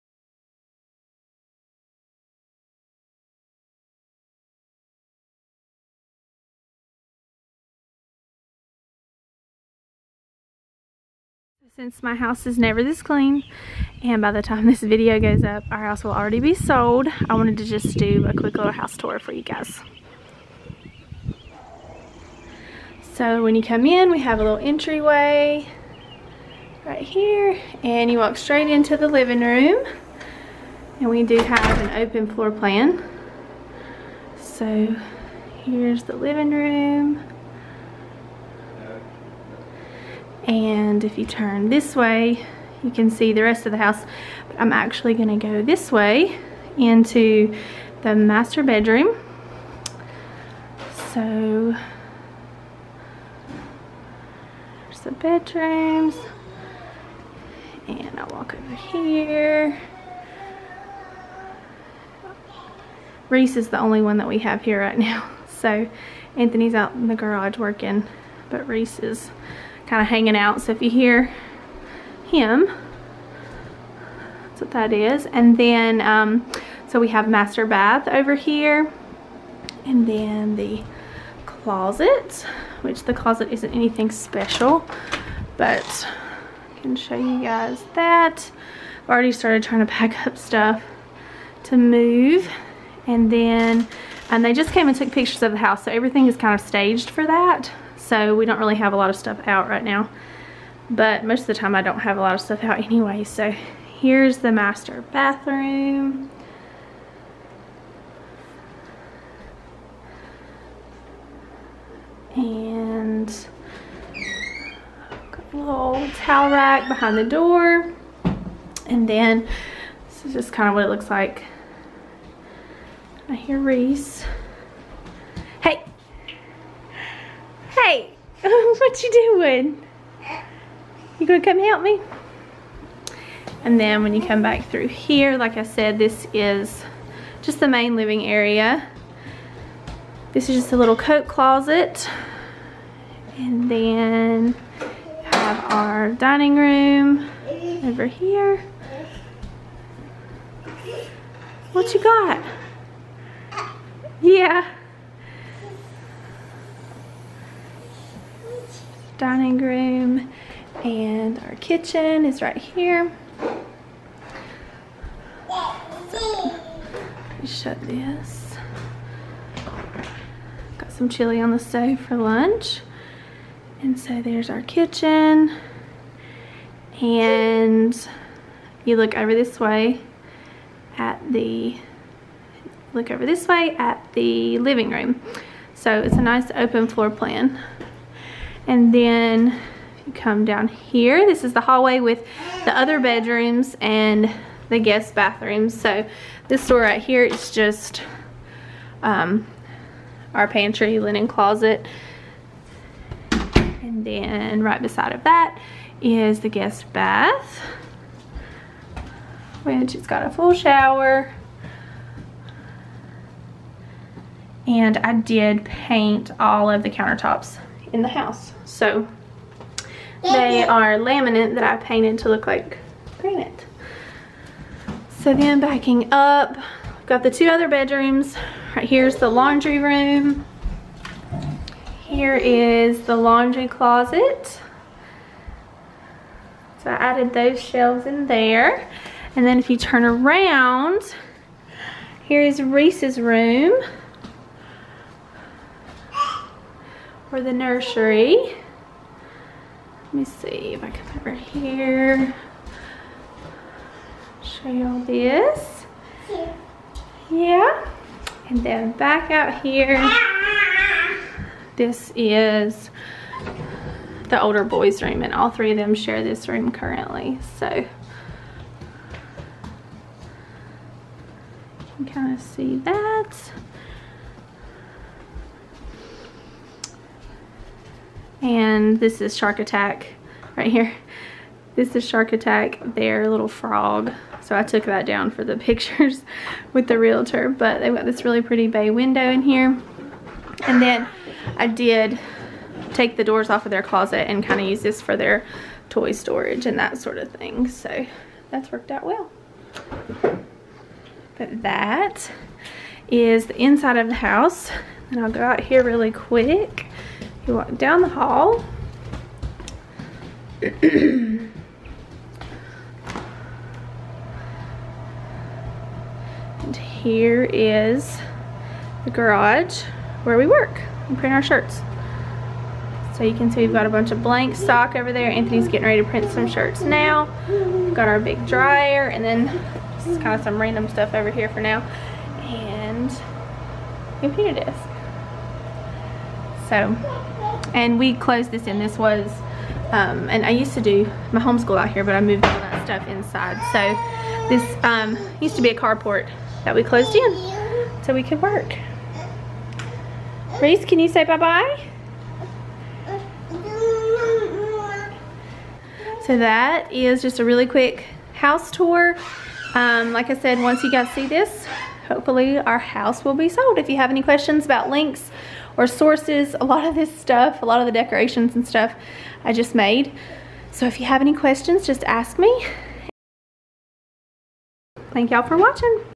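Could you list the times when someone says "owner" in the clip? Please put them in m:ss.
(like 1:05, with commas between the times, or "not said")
not said.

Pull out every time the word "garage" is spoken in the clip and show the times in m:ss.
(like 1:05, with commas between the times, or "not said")
1:07, 5:19.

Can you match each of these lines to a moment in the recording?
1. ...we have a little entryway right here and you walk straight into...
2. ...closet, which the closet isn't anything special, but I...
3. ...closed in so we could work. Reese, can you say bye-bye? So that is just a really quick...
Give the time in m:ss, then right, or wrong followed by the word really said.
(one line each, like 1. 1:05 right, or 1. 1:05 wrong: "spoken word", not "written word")
1. 0:24 right
2. 1:21 right
3. 5:46 right.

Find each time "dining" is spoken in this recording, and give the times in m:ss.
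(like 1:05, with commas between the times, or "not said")
2:26, 2:39.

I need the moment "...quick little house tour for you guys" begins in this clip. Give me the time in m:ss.
0:18.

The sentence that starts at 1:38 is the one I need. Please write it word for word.
So we don't really have a lot of stuff out right now.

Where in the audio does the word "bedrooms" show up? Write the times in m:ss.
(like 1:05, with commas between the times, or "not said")
0:48, 0:55, 3:12, 3:47.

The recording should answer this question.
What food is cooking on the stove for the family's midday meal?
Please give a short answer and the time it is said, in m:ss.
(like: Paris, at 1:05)
Chili, at 2:51.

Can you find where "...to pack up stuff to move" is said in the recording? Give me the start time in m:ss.
1:29.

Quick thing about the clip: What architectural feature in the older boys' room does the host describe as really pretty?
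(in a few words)
Bay window.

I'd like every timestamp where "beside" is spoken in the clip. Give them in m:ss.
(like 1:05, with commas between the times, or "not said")
3:24.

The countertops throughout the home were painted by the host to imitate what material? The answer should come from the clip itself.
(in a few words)
Granite.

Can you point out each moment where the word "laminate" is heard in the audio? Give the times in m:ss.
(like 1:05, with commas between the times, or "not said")
3:40.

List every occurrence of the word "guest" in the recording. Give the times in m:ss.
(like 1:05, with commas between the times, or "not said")
3:14, 3:26.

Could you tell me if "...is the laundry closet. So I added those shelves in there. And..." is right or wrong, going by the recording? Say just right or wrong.
right.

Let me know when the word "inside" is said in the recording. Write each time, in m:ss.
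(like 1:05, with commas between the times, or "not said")
5:03, 5:43.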